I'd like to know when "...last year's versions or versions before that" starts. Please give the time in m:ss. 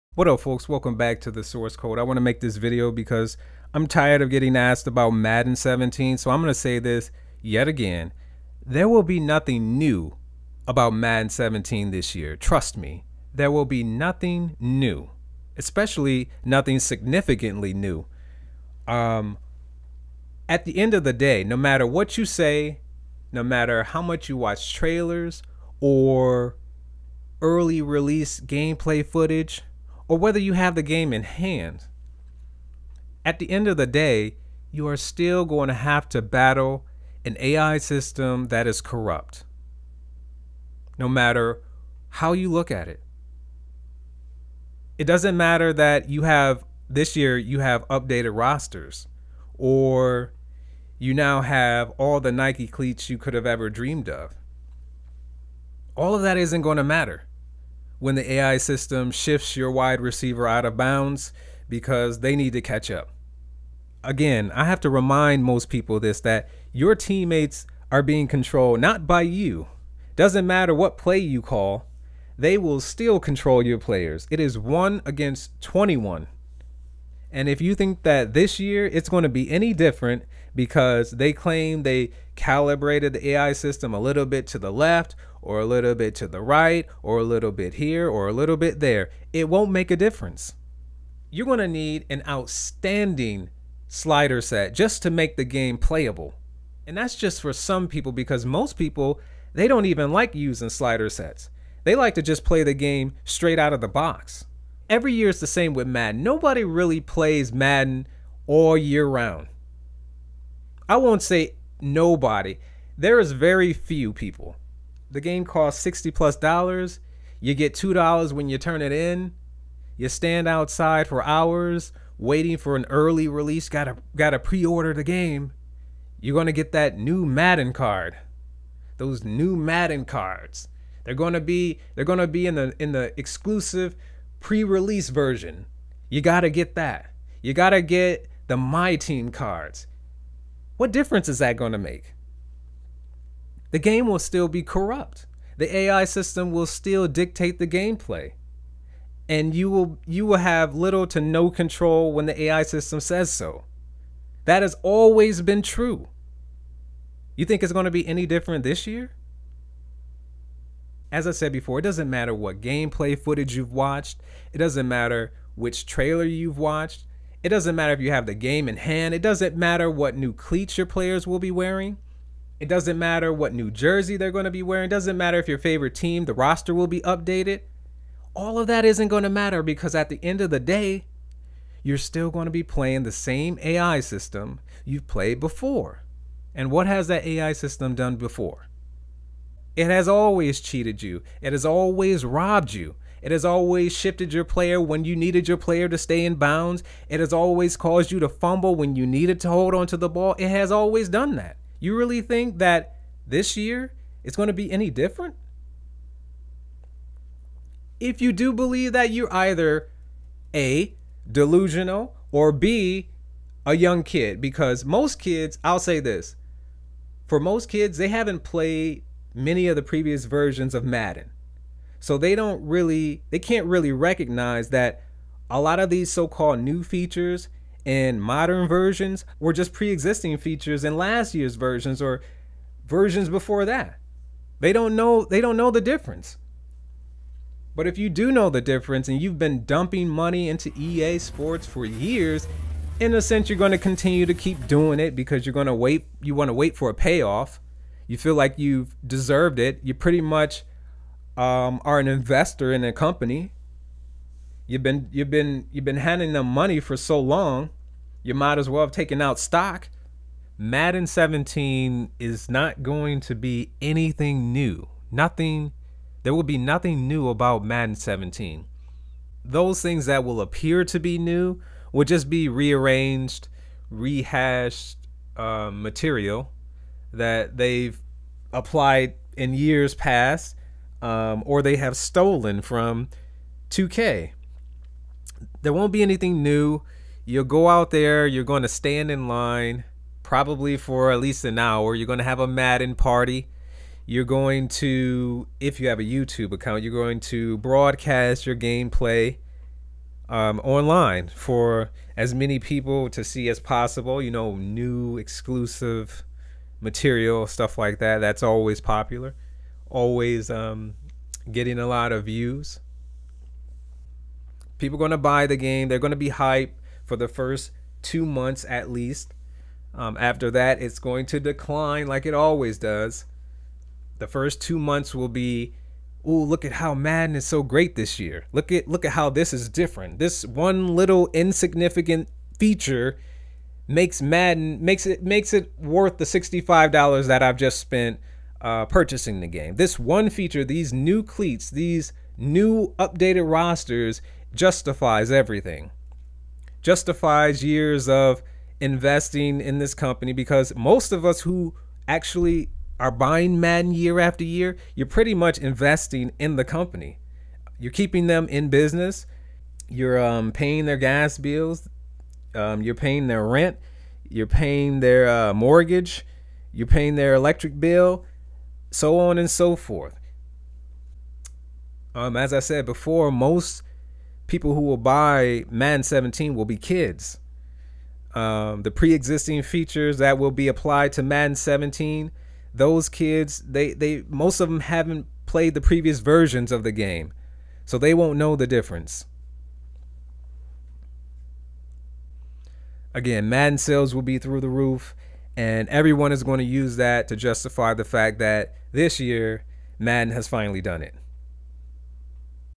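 3:50.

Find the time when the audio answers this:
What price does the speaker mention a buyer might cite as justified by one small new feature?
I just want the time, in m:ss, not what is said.
5:36.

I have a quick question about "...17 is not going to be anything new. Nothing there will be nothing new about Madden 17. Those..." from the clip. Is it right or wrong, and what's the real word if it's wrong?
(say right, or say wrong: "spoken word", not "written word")
right.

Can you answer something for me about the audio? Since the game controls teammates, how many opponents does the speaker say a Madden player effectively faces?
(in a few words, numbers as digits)
1 against 21.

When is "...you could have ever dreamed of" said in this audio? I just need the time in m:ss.
0:53.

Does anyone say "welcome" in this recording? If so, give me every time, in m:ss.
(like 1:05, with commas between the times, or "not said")
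0:00.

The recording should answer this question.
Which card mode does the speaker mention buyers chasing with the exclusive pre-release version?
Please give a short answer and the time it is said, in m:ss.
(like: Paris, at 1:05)
My Team, at 2:18.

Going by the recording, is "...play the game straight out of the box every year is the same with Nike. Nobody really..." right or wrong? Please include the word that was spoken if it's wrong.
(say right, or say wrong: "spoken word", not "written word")
wrong: "Madden", not "Nike".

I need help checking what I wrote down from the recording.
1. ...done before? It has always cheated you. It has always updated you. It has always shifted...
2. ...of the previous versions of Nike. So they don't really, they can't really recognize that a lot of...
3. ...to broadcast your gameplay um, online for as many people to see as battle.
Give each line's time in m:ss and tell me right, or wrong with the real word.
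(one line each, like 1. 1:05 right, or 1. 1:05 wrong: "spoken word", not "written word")
1. 3:07 wrong: "robbed", not "updated"
2. 3:39 wrong: "Madden", not "Nike"
3. 4:57 wrong: "possible", not "battle".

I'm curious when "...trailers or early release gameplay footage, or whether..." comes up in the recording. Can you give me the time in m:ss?
0:24.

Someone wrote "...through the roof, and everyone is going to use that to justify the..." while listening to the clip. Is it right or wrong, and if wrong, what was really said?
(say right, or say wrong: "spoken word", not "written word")
right.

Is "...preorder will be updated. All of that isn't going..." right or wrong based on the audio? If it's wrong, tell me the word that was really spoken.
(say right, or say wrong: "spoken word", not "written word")
wrong: "roster", not "preorder".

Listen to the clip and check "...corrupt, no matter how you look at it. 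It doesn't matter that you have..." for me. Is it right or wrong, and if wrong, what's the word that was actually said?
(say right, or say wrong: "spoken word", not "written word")
right.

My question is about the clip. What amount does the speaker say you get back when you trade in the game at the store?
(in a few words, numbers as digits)
$2.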